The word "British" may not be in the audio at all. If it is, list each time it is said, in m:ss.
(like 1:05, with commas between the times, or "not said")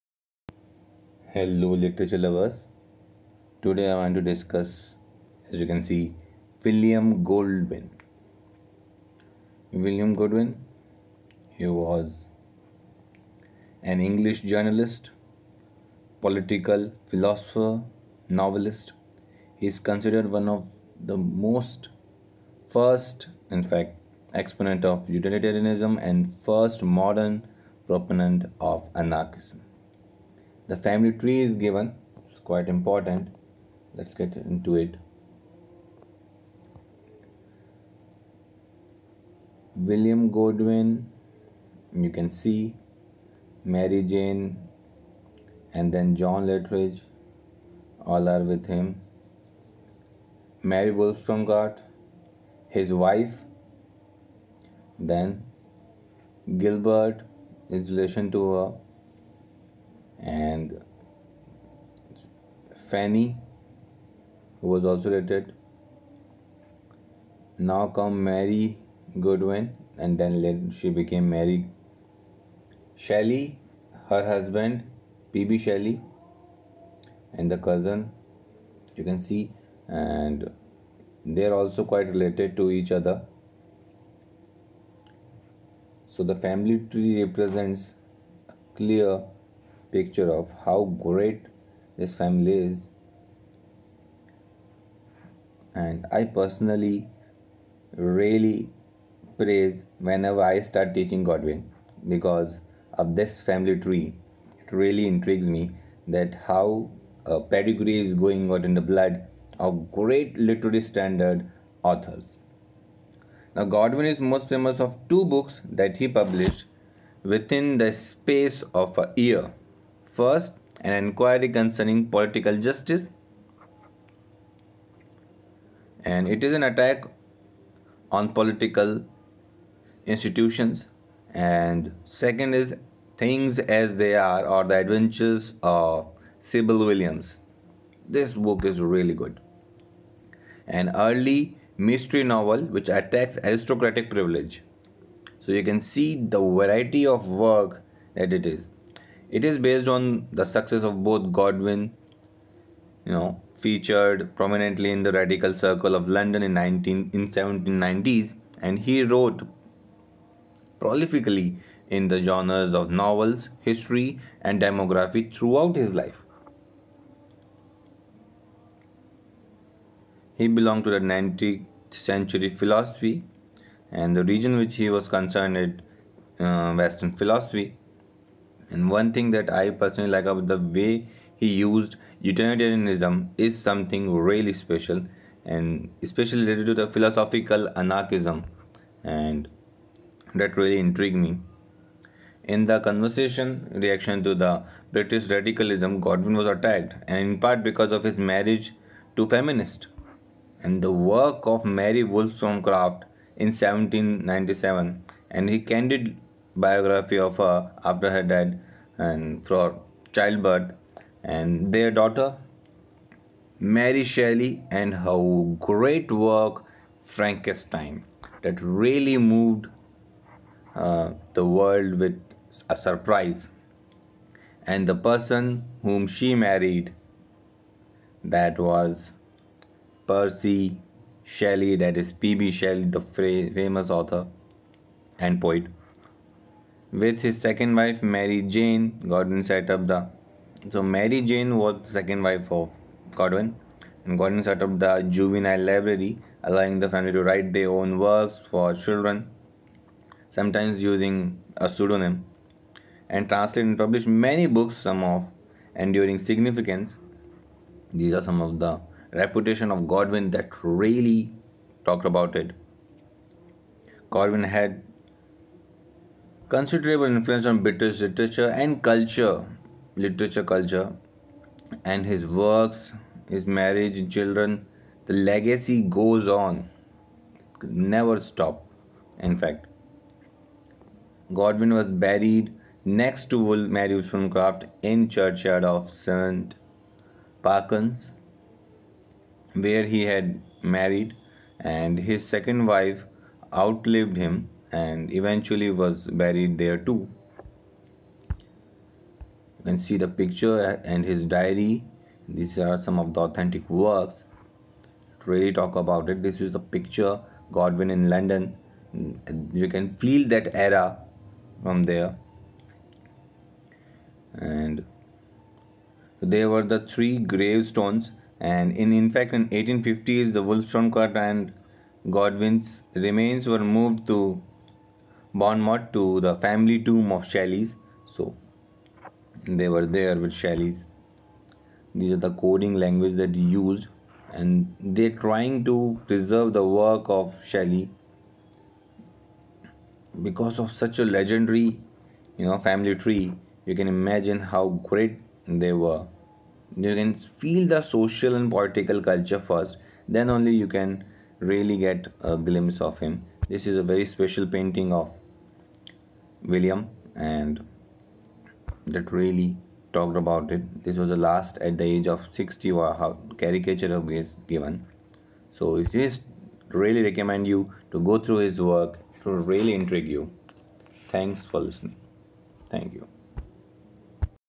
3:14, 4:27.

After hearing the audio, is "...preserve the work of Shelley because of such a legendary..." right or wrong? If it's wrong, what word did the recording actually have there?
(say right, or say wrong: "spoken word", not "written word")
right.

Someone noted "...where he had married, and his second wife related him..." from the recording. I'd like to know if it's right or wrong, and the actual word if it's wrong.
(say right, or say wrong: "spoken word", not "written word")
wrong: "outlived", not "related".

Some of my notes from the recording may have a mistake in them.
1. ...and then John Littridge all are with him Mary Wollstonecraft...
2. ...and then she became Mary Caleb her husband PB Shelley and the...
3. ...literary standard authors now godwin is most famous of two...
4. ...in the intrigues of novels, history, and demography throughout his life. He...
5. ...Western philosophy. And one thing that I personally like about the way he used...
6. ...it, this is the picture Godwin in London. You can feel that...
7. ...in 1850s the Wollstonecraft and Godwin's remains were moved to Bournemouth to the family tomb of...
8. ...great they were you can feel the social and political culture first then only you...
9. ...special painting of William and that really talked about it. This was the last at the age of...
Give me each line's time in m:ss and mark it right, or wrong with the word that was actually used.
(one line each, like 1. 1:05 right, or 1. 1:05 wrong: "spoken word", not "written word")
1. 0:45 right
2. 1:09 wrong: "Shelley", not "Caleb"
3. 1:50 right
4. 2:41 wrong: "genres", not "intrigues"
5. 2:56 right
6. 5:06 right
7. 5:19 right
8. 5:44 right
9. 5:54 right.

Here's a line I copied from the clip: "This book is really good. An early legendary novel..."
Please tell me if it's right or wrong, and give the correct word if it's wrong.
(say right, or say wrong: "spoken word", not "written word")
wrong: "mystery", not "legendary".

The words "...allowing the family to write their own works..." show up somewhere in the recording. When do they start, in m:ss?
4:06.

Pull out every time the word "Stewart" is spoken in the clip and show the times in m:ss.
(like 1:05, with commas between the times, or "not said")
not said.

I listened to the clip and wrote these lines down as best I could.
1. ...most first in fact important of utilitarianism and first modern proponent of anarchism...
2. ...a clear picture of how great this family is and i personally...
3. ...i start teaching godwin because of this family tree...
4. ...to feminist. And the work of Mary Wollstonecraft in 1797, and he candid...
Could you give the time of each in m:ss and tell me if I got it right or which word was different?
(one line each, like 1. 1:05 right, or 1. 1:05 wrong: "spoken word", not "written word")
1. 0:21 wrong: "exponent", not "important"
2. 1:28 right
3. 1:40 right
4. 3:19 right.